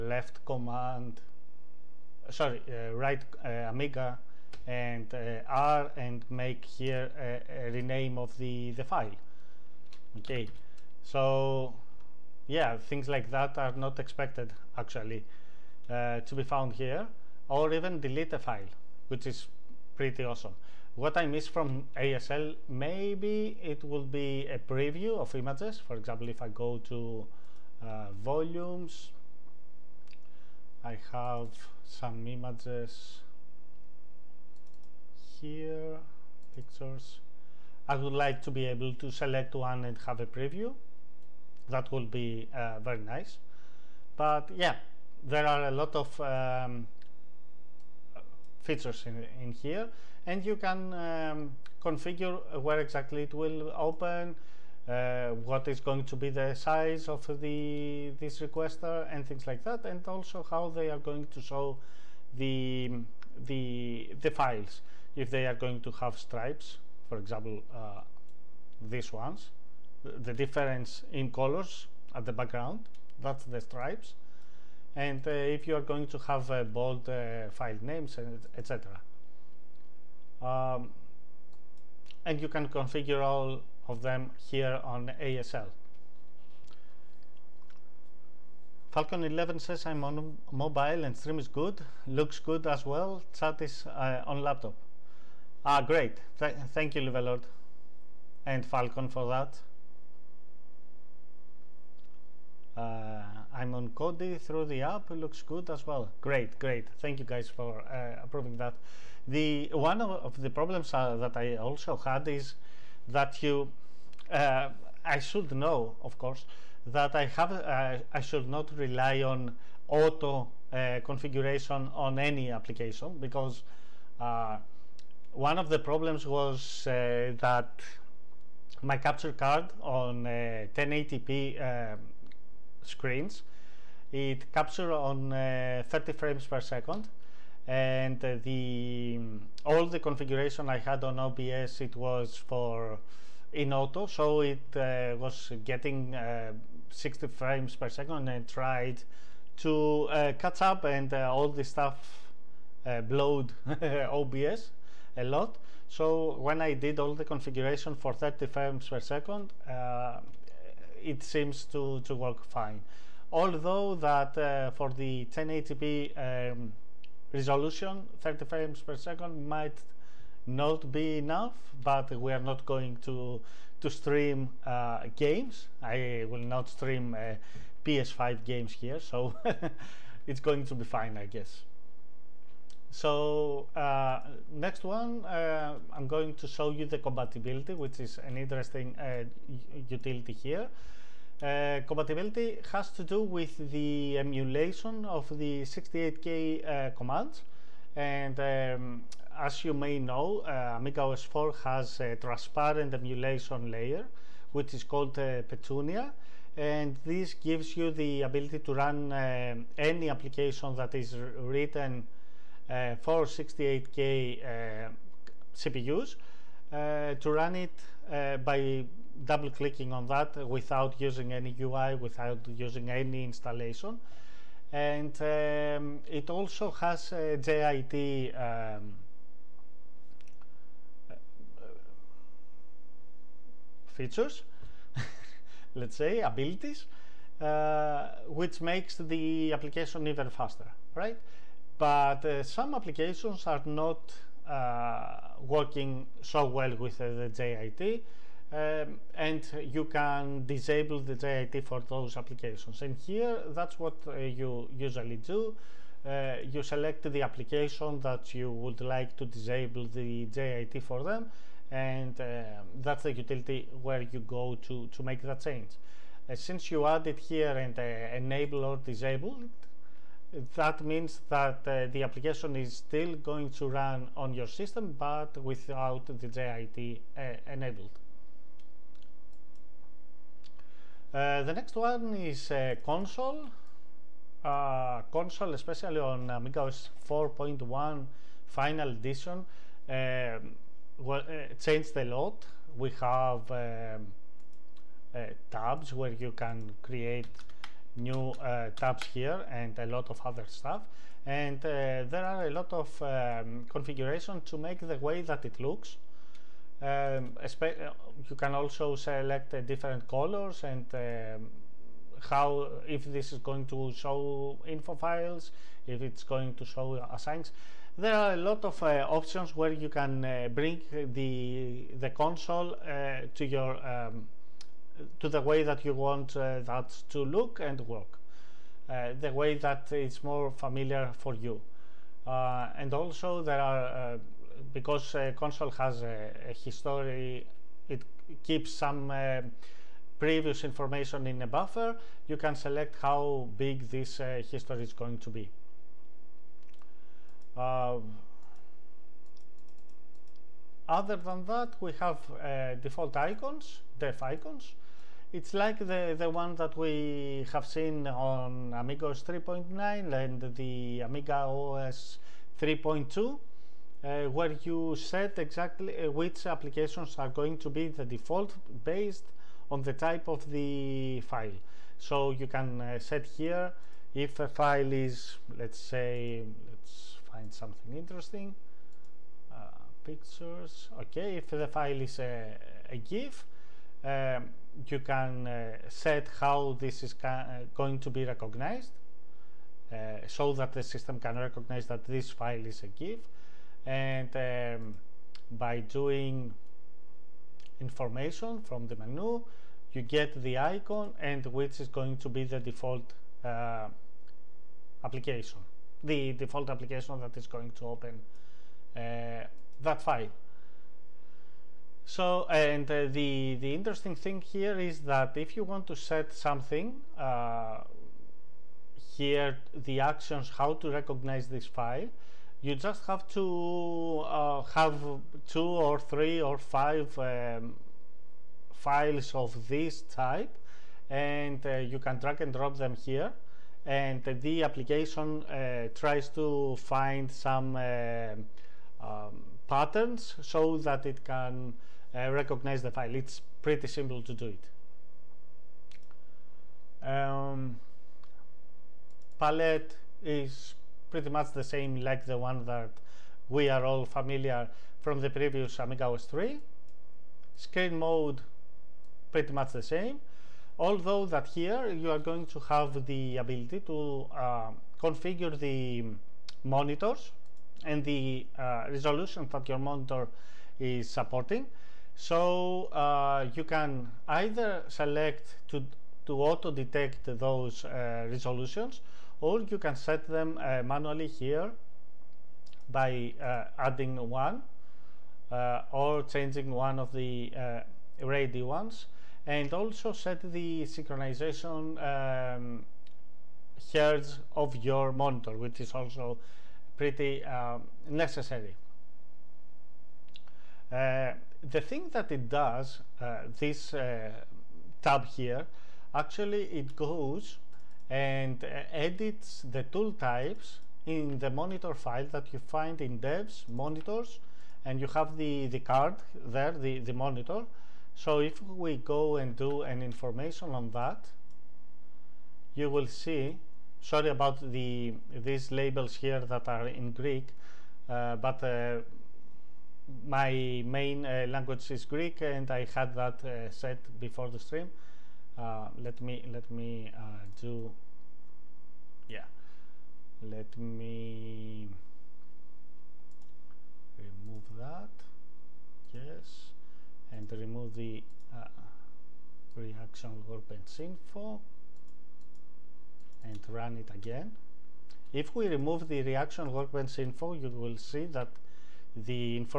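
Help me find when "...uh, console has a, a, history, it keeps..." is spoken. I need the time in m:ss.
5:35.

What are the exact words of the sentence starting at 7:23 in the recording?
It's pretty simple to do it.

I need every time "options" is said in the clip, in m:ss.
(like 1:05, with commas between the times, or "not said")
5:19.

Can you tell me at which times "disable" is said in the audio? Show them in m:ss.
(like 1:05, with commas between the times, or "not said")
4:10, 4:19, 4:28.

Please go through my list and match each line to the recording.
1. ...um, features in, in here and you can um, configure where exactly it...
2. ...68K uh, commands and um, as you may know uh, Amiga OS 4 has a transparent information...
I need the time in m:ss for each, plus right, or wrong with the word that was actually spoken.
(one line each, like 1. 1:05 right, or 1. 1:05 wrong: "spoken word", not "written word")
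1. 0:46 right
2. 3:15 wrong: "emulation", not "information".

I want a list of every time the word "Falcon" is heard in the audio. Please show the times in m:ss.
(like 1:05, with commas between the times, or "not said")
1:28, 1:38.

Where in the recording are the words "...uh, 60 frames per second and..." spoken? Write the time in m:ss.
2:26.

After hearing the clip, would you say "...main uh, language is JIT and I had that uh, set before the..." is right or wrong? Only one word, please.
wrong.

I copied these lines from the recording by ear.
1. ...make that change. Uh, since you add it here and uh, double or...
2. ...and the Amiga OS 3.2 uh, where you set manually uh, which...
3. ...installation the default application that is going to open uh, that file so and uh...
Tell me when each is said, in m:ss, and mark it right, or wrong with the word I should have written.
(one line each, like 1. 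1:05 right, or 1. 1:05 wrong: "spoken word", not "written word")
1. 4:25 wrong: "enable", not "double"
2. 6:00 wrong: "exactly", not "manually"
3. 6:45 wrong: "application", not "installation".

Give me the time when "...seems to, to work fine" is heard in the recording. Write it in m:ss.
2:41.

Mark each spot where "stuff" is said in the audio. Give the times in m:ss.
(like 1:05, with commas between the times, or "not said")
2:31, 5:00.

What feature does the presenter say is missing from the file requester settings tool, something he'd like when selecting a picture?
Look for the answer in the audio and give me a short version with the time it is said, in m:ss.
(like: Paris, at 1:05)
preview of images, at 0:24.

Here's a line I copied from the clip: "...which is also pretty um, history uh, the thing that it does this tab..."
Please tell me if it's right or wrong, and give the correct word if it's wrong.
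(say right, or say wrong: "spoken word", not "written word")
wrong: "necessary", not "history".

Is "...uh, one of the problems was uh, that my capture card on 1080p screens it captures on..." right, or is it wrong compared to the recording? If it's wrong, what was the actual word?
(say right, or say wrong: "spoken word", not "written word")
right.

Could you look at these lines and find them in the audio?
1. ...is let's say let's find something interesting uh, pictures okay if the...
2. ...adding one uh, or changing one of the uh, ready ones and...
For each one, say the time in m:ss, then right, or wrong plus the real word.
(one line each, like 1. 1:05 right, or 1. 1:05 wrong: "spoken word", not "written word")
1. 6:14 right
2. 8:03 right.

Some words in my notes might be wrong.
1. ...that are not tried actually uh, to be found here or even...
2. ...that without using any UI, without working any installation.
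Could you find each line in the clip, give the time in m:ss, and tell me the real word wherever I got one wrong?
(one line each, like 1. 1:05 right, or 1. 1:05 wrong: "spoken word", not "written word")
1. 0:13 wrong: "expected", not "tried"
2. 3:40 wrong: "using", not "working".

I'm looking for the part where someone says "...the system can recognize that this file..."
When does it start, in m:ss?
6:30.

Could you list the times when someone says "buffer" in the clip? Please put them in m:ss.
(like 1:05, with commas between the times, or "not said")
5:41.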